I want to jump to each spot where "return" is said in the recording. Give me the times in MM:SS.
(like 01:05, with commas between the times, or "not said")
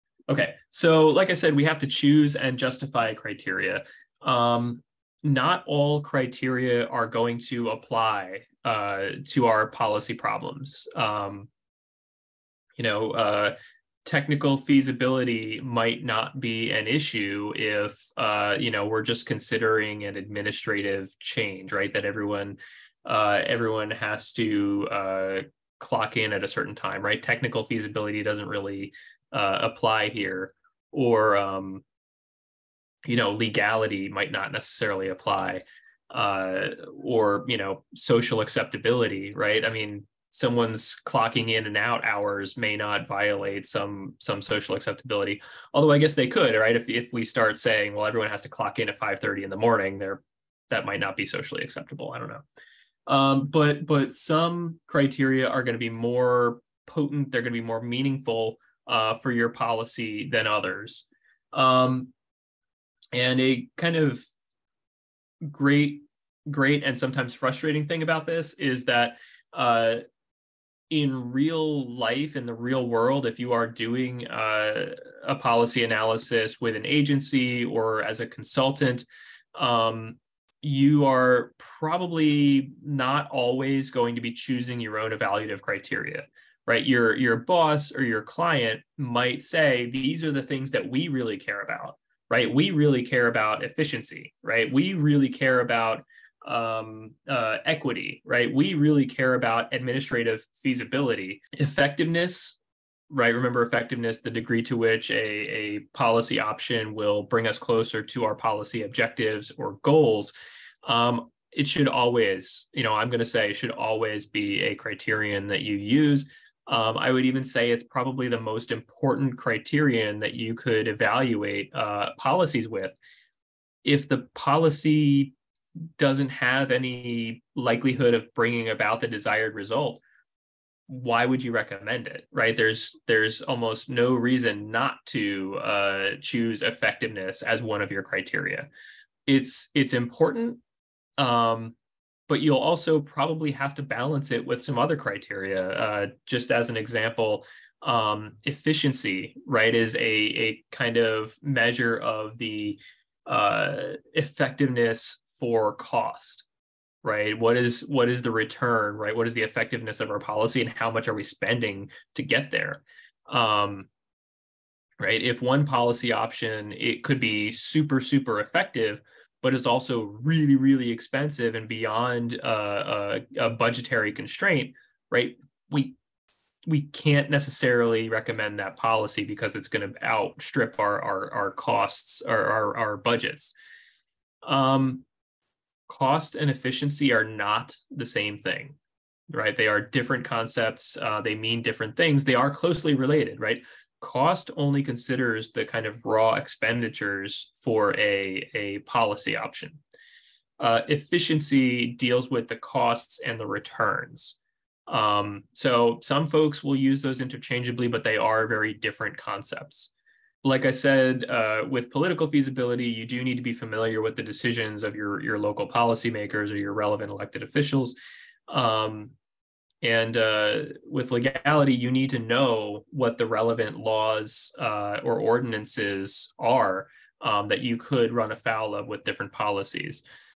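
02:38, 03:23.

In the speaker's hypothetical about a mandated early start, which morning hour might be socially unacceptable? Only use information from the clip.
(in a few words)
5:30.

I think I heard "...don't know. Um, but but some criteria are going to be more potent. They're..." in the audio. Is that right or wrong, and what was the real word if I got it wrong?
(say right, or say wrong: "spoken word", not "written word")
right.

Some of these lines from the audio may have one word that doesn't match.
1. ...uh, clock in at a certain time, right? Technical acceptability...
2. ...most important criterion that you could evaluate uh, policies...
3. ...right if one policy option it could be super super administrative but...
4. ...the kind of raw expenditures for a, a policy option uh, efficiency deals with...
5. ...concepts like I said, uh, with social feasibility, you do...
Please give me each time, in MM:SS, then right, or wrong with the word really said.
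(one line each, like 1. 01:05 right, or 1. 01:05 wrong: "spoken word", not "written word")
1. 00:24 wrong: "feasibility", not "acceptability"
2. 01:58 right
3. 02:44 wrong: "effective", not "administrative"
4. 03:15 right
5. 03:29 wrong: "political", not "social".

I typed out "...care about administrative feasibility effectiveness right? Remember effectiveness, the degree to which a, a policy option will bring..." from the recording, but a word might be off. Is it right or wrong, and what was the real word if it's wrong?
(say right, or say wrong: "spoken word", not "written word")
right.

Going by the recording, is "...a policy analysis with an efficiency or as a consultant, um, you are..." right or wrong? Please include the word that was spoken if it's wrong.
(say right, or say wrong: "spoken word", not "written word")
wrong: "agency", not "efficiency".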